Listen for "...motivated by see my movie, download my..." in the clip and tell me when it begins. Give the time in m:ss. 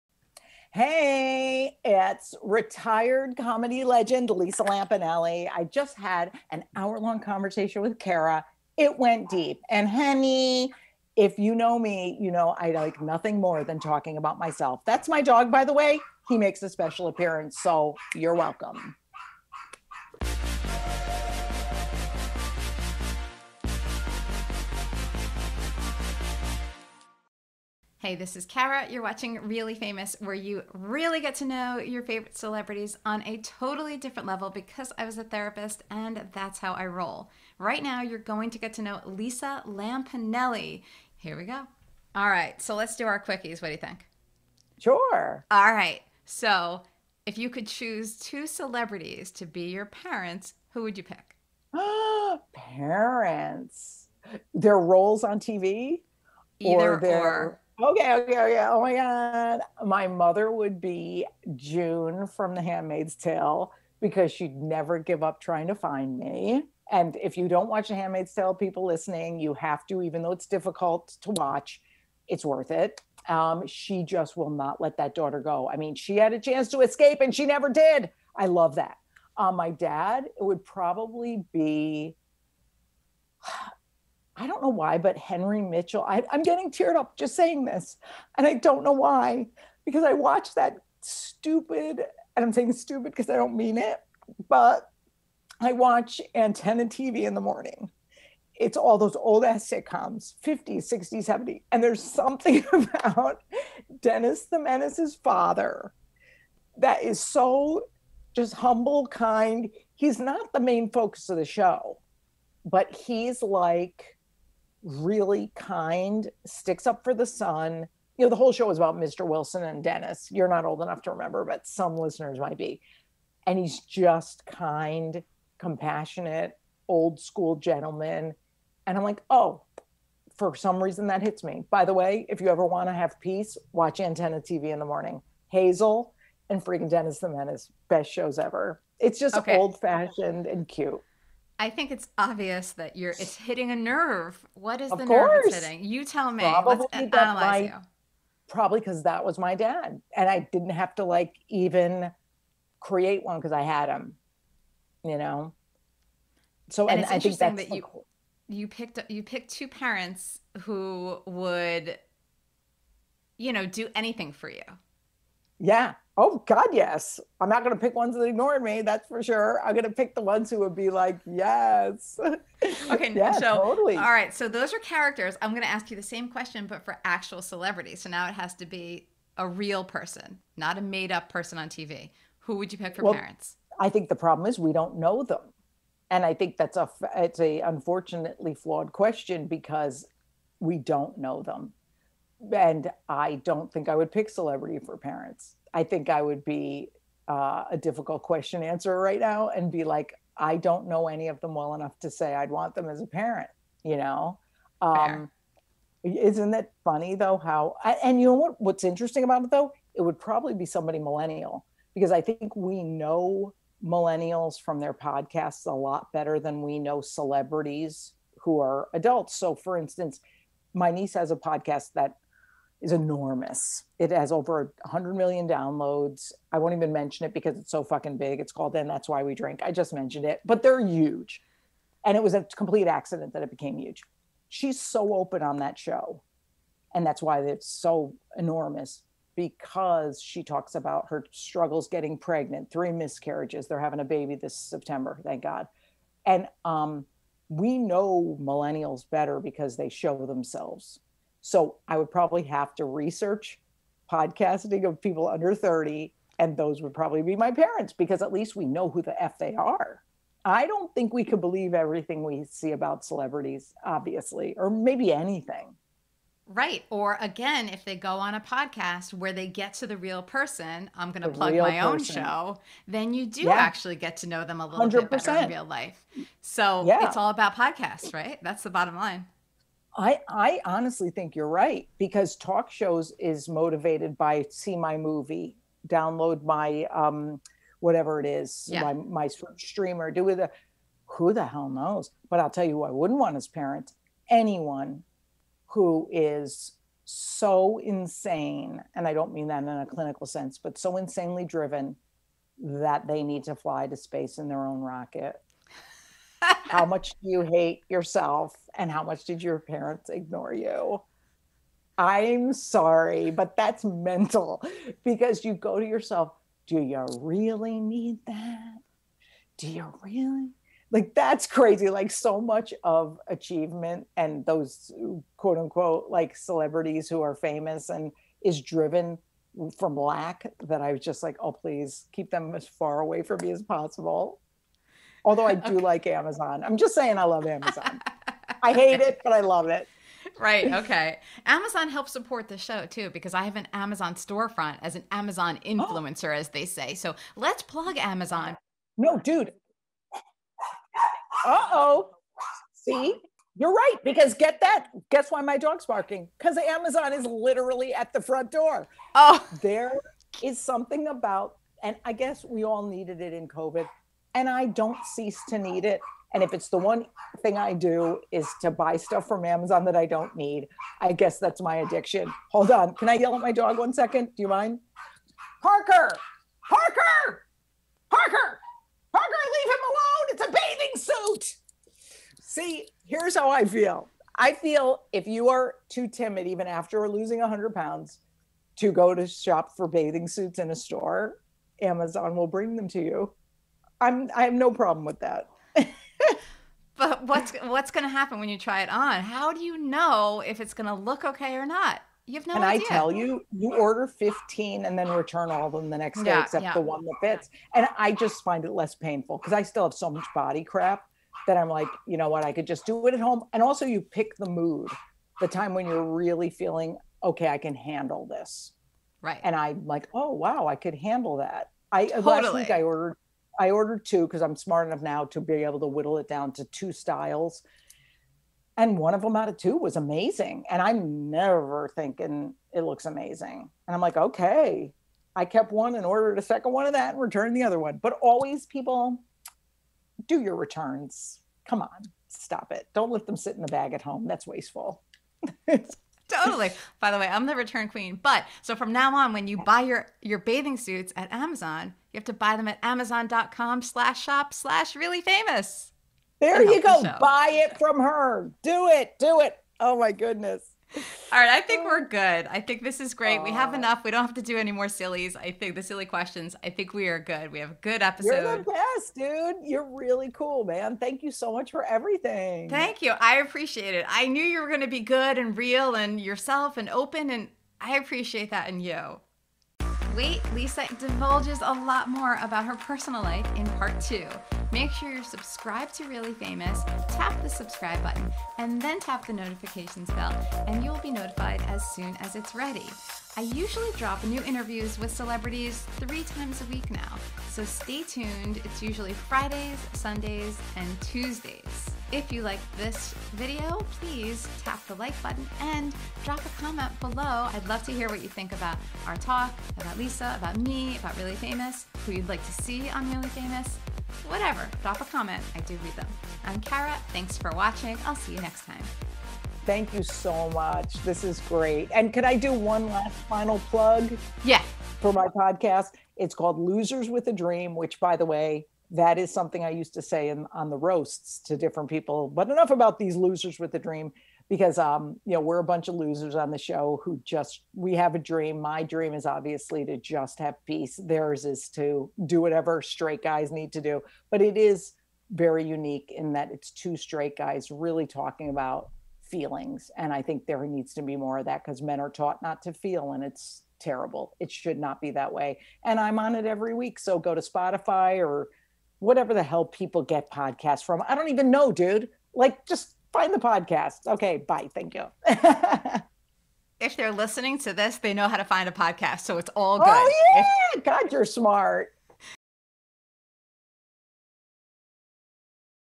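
4:43.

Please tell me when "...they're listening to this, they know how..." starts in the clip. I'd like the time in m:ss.
9:26.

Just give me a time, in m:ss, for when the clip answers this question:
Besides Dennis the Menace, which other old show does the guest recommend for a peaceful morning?
2:15.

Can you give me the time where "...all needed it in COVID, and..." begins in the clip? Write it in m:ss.
6:02.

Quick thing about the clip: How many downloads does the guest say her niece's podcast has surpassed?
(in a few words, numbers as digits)
100 million.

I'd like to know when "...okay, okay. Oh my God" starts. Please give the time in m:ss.
0:58.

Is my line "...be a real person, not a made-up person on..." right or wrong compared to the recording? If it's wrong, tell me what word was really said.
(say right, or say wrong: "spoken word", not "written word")
right.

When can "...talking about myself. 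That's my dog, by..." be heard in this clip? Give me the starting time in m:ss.
0:13.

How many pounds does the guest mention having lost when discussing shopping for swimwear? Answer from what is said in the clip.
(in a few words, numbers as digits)
100.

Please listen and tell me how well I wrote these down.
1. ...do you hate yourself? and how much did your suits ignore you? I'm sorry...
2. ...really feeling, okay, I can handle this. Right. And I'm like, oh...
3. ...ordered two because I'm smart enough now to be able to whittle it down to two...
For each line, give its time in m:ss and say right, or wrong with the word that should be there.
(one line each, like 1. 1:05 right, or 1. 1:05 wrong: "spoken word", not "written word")
1. 5:07 wrong: "parents", not "suits"
2. 6:56 right
3. 7:03 right.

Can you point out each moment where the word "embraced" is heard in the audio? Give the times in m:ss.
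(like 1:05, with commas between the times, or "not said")
not said.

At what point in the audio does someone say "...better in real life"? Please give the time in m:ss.
4:35.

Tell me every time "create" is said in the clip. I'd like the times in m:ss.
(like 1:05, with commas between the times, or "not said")
2:32.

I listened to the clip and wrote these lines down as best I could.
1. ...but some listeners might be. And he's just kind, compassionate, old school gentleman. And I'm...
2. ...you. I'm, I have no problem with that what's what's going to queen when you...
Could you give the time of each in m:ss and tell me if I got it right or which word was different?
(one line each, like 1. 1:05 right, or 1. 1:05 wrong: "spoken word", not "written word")
1. 2:01 right
2. 6:33 wrong: "happen", not "queen".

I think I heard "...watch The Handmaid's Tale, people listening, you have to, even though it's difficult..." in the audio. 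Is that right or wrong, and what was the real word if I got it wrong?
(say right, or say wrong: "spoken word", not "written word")
right.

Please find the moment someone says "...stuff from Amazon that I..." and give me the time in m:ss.
6:08.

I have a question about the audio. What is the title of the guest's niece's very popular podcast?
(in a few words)
And That's Why We Drink.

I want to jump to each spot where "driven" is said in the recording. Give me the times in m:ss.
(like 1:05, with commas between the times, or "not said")
5:01, 5:28.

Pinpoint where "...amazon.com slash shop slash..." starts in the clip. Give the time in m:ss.
7:32.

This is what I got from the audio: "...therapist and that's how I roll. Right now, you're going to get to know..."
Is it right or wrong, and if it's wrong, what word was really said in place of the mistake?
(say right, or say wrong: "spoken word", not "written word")
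right.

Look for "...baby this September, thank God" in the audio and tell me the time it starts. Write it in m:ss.
4:04.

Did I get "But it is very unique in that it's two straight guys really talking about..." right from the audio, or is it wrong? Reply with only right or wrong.
right.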